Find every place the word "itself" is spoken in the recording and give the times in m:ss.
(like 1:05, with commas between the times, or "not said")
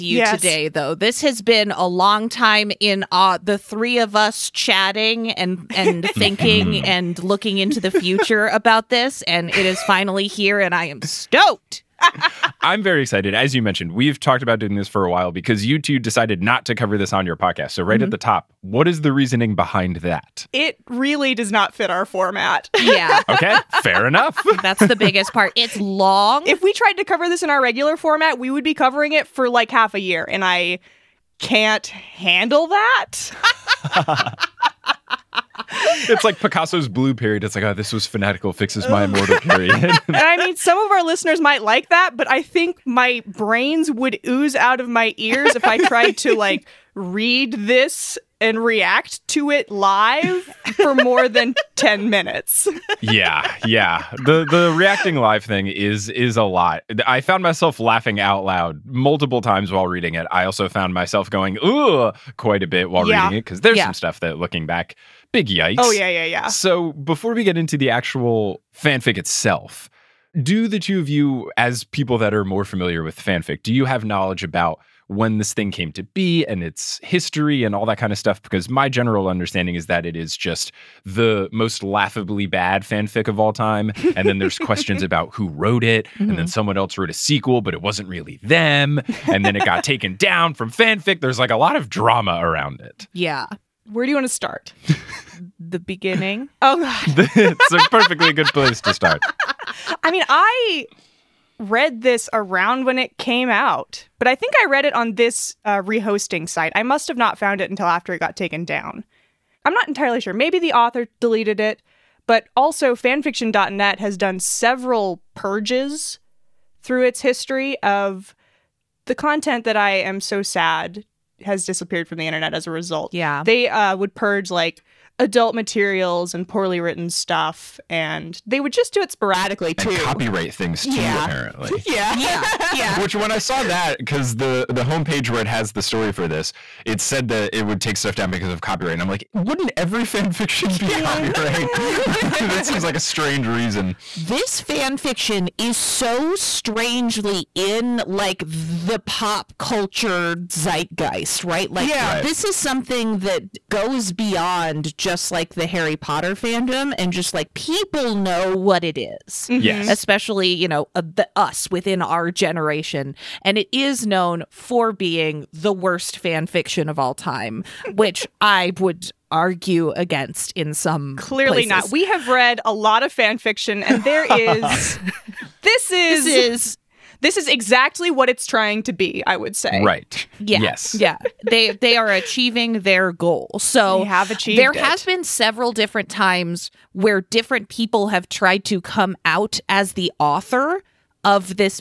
1:09.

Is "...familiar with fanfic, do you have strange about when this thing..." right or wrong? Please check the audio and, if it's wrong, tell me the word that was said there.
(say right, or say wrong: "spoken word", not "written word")
wrong: "knowledge", not "strange".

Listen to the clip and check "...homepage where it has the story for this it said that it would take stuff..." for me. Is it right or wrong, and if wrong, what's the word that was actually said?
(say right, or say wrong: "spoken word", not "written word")
right.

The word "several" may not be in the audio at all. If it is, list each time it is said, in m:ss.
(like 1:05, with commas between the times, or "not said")
1:54, 3:05.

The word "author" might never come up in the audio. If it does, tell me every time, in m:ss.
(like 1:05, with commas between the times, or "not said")
1:50, 3:10.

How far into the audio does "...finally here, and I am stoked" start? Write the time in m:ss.
0:09.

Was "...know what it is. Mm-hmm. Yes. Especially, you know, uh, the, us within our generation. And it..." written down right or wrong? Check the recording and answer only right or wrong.
right.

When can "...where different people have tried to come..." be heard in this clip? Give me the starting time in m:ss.
3:06.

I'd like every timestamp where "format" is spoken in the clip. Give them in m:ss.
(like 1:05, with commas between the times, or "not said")
0:22, 0:27.